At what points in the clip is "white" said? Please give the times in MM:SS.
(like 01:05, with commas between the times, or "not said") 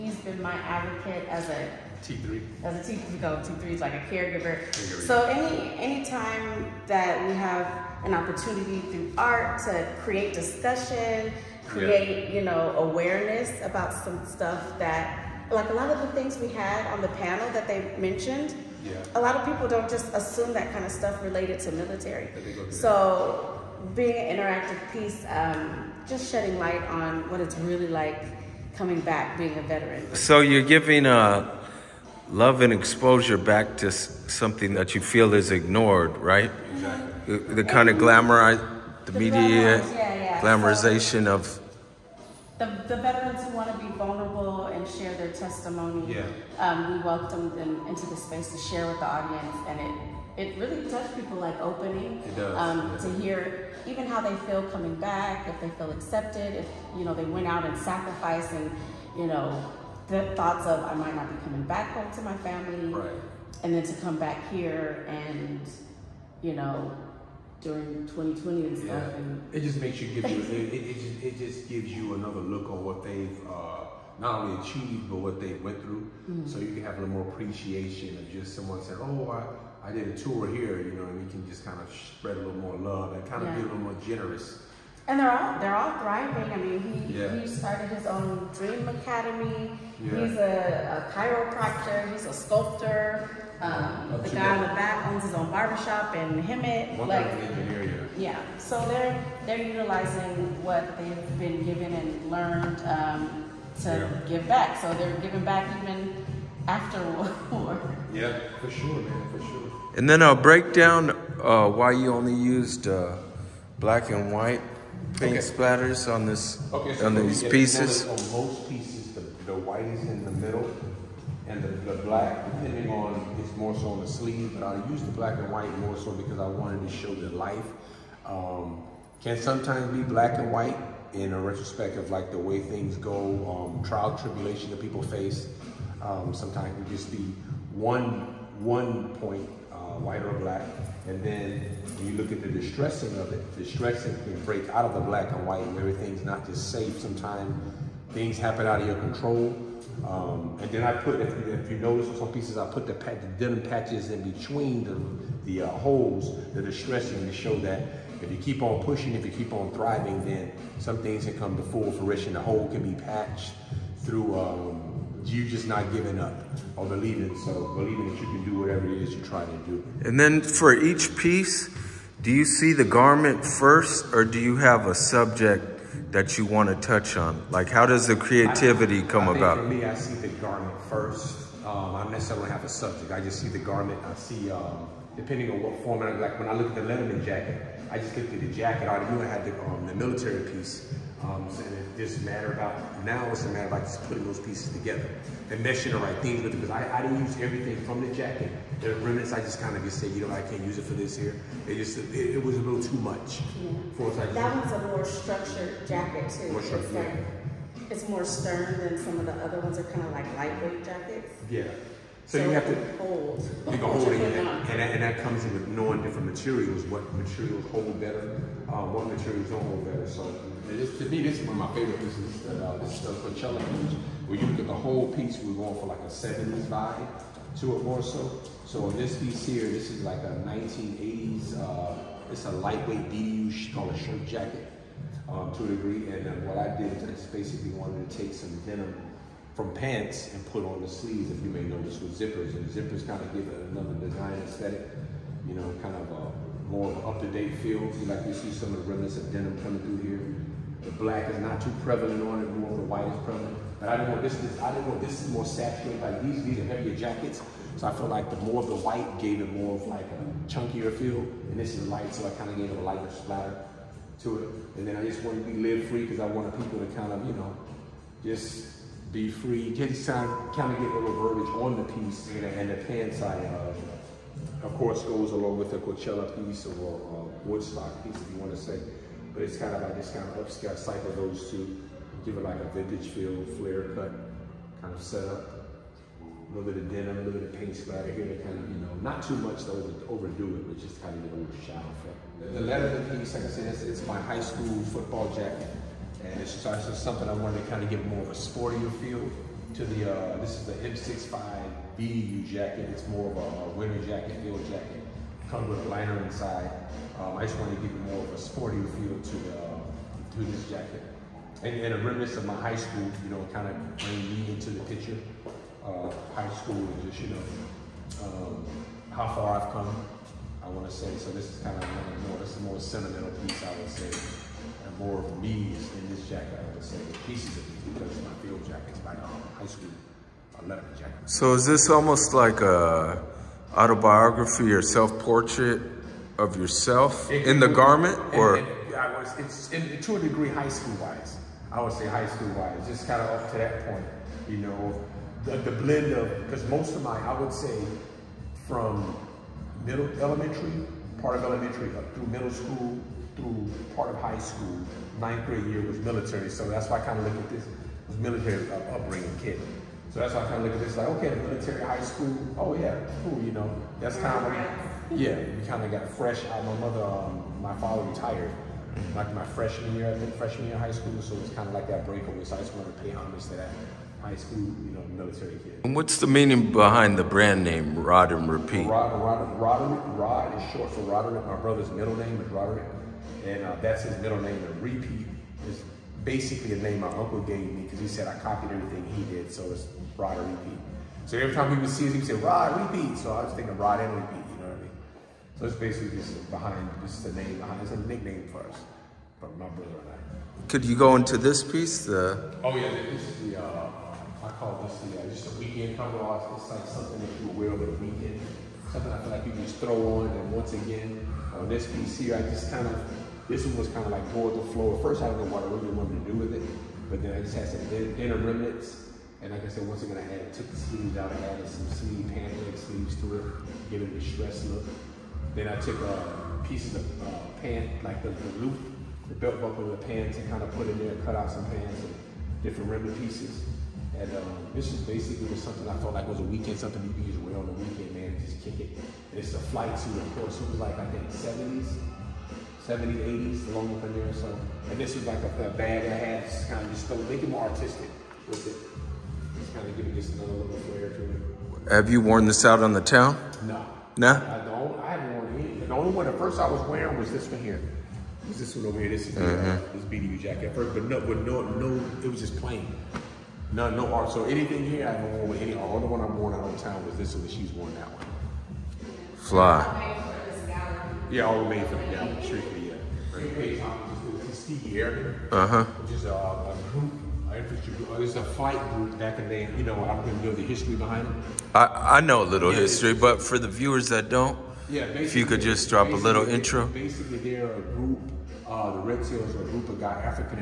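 01:54, 01:59, 02:05, 02:10, 02:19, 02:25, 04:12, 04:18.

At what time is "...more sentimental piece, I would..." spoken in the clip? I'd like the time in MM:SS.
05:22.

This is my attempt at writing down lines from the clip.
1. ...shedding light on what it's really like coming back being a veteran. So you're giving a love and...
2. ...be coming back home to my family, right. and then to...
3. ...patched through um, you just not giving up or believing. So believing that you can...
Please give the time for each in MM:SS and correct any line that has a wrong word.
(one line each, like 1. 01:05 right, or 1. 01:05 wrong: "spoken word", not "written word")
1. 00:26 right
2. 01:01 right
3. 02:43 right.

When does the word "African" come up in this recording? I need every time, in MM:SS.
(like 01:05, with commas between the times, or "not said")
08:10.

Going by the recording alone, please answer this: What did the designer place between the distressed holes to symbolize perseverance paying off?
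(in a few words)
Denim patches.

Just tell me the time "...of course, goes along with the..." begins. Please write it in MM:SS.
04:34.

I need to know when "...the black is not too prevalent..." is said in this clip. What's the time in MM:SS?
04:10.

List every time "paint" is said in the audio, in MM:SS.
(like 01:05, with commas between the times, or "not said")
01:55, 04:47.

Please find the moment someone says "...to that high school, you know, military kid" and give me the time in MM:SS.
06:13.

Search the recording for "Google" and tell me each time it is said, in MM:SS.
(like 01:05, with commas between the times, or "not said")
not said.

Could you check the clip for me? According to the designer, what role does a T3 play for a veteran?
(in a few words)
Caregiver.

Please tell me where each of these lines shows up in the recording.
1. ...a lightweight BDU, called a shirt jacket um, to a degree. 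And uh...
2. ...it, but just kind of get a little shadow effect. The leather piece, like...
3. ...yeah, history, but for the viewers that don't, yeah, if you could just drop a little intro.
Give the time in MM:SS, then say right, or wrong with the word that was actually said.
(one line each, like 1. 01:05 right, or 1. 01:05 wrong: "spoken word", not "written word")
1. 03:52 right
2. 04:50 right
3. 08:02 right.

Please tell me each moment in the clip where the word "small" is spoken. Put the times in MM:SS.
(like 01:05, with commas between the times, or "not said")
not said.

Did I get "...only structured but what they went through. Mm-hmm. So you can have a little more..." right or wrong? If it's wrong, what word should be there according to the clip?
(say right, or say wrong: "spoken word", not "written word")
wrong: "achieved", not "structured".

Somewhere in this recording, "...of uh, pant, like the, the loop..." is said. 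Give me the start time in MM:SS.
07:06.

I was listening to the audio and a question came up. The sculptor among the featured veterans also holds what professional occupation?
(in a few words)
Chiropractor.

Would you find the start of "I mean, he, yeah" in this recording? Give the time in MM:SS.
01:26.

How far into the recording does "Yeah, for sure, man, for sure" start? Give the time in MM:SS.
01:48.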